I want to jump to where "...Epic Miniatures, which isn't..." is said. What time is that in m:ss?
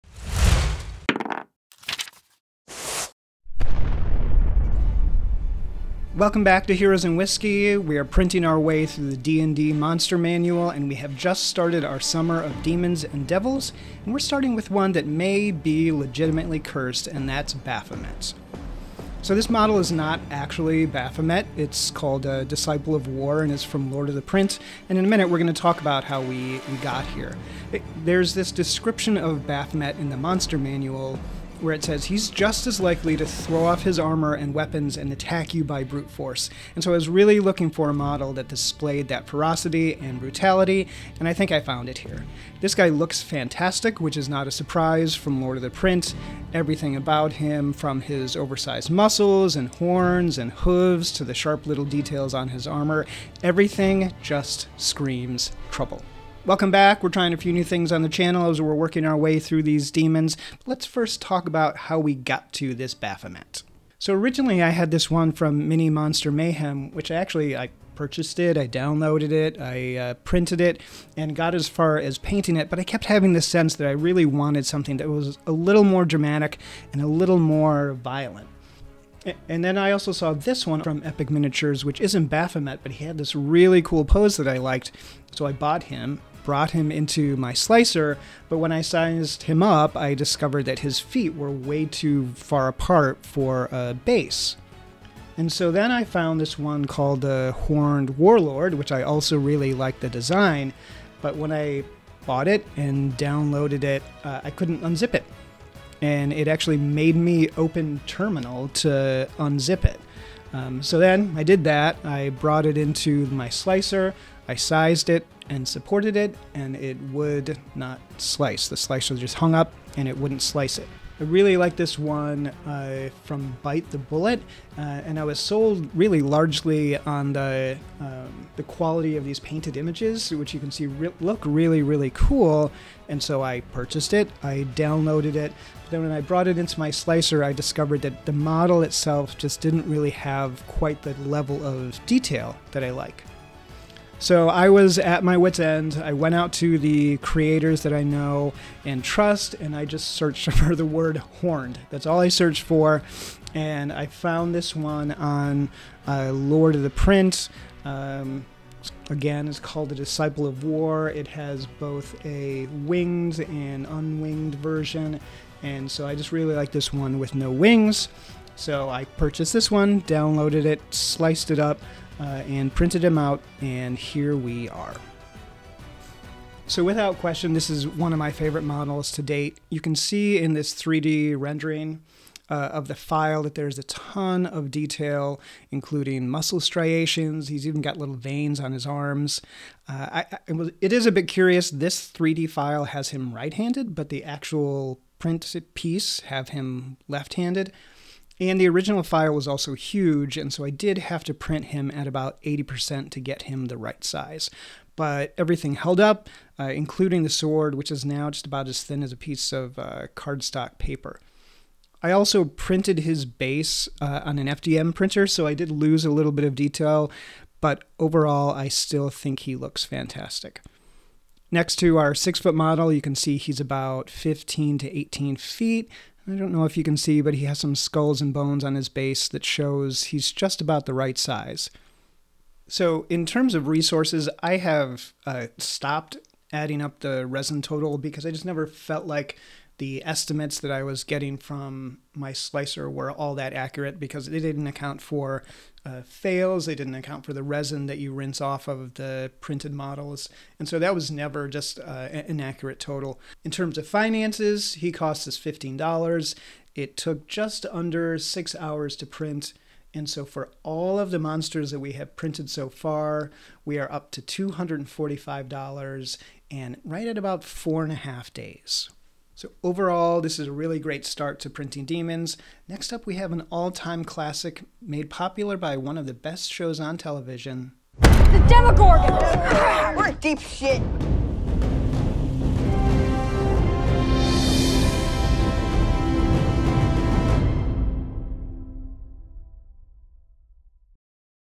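1:21.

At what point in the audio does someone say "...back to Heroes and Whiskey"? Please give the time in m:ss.
0:06.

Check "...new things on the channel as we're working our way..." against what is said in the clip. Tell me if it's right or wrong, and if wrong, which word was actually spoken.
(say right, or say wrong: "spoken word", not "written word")
right.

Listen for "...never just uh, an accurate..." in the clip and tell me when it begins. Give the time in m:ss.
4:11.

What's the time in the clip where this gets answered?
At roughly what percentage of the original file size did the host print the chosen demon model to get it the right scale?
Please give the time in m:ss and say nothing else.
3:22.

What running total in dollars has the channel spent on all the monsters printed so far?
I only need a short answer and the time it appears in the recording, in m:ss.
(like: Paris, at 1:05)
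$245, at 4:24.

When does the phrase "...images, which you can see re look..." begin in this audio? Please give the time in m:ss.
2:09.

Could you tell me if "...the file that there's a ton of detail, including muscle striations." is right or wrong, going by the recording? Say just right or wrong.
right.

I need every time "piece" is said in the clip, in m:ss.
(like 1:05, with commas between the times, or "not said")
3:15, 3:29.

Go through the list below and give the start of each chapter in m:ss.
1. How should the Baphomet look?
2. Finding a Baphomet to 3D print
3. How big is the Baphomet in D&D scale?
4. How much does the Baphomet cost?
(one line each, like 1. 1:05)
1. 2:56
2. 1:04
3. 3:42
4. 3:53.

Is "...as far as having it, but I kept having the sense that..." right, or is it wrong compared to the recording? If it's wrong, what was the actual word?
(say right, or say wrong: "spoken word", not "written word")
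wrong: "painting", not "having".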